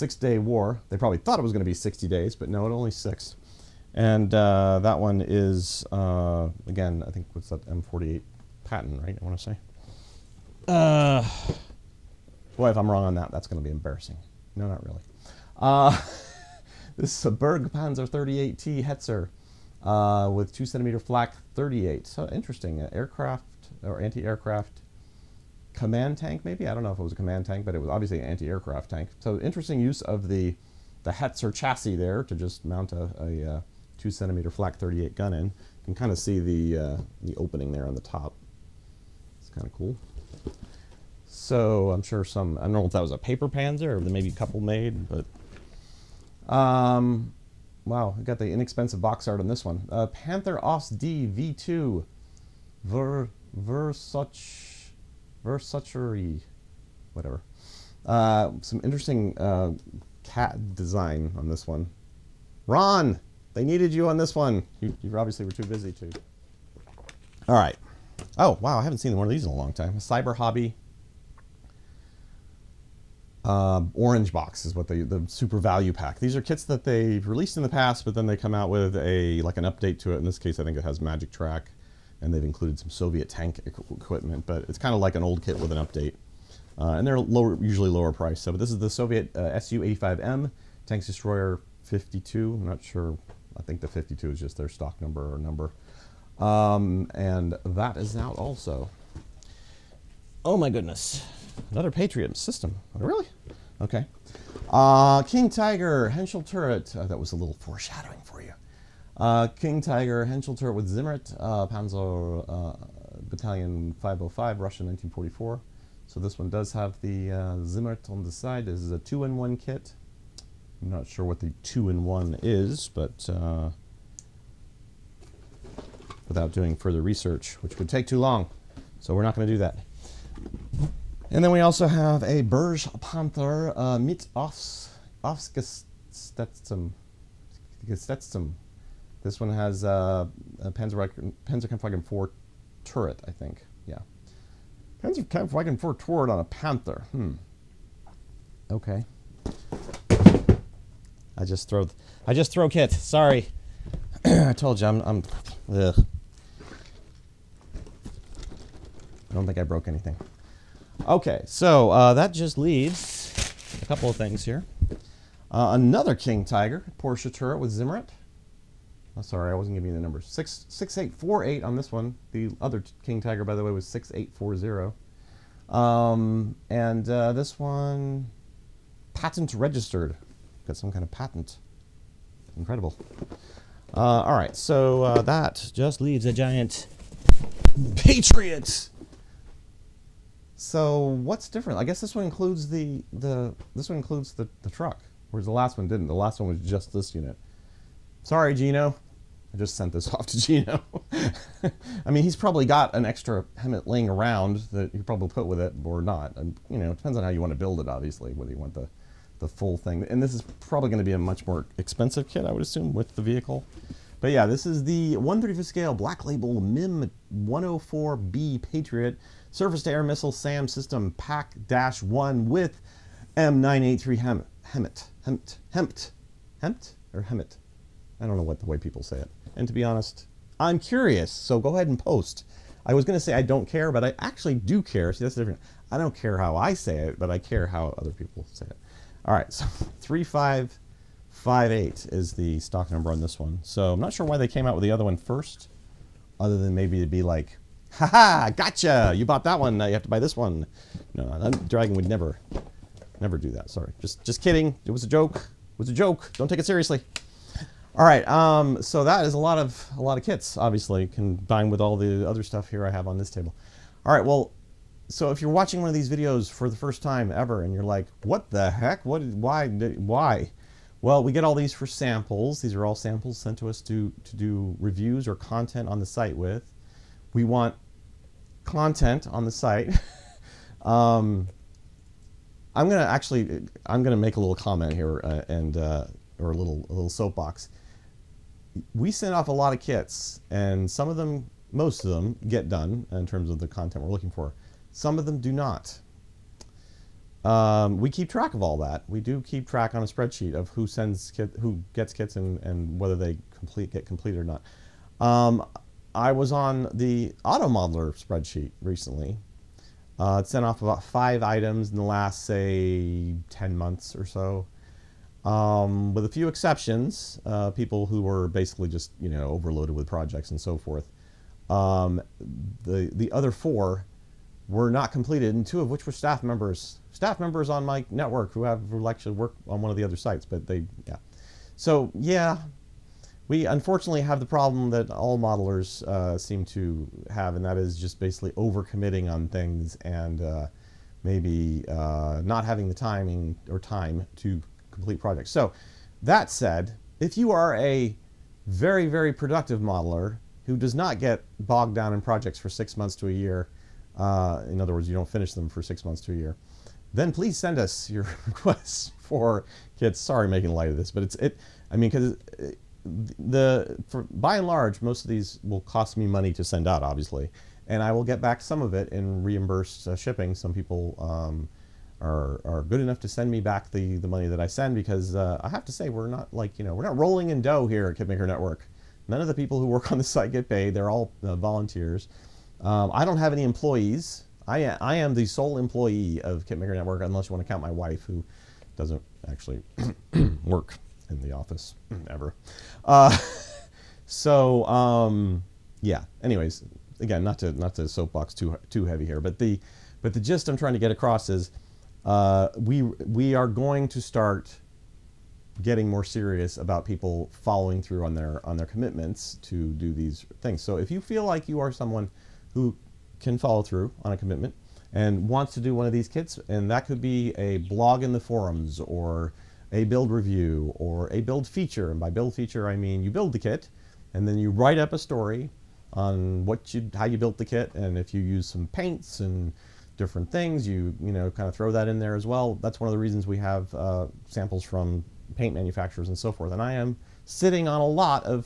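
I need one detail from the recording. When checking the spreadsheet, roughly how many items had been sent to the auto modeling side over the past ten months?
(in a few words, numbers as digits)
5.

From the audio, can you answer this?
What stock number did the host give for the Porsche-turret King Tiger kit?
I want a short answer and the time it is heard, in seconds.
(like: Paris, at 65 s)
6848, at 170 s.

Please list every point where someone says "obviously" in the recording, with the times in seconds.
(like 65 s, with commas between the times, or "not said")
27 s, 65 s, 207 s, 260 s, 367 s.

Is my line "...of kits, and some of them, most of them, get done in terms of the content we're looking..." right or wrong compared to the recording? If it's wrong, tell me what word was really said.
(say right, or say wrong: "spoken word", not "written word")
right.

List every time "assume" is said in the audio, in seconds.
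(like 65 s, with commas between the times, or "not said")
212 s.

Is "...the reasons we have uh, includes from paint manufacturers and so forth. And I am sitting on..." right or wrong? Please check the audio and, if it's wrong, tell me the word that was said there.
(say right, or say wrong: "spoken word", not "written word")
wrong: "samples", not "includes".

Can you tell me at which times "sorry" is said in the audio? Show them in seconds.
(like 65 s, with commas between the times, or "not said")
152 s, 169 s, 198 s, 253 s, 360 s.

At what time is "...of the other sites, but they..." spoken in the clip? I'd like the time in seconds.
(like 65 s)
329 s.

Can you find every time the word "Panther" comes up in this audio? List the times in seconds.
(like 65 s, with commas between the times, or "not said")
50 s, 133 s, 146 s.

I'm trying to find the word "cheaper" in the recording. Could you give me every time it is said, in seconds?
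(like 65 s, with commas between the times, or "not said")
not said.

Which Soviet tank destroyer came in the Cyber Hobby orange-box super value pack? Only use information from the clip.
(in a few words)
Su-85M.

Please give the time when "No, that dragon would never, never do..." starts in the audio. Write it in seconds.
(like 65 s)
251 s.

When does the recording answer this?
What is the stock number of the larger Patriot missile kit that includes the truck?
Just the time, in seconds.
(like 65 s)
239 s.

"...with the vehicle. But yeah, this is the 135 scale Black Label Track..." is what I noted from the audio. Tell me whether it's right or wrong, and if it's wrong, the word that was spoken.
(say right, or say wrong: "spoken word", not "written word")
wrong: "MIM", not "Track".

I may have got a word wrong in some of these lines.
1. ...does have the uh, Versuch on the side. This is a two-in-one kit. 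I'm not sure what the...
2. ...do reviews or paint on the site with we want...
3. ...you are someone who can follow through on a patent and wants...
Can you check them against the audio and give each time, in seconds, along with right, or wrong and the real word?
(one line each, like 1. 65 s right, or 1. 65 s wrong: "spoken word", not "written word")
1. 116 s wrong: "Zimmert", not "Versuch"
2. 274 s wrong: "content", not "paint"
3. 411 s wrong: "commitment", not "patent".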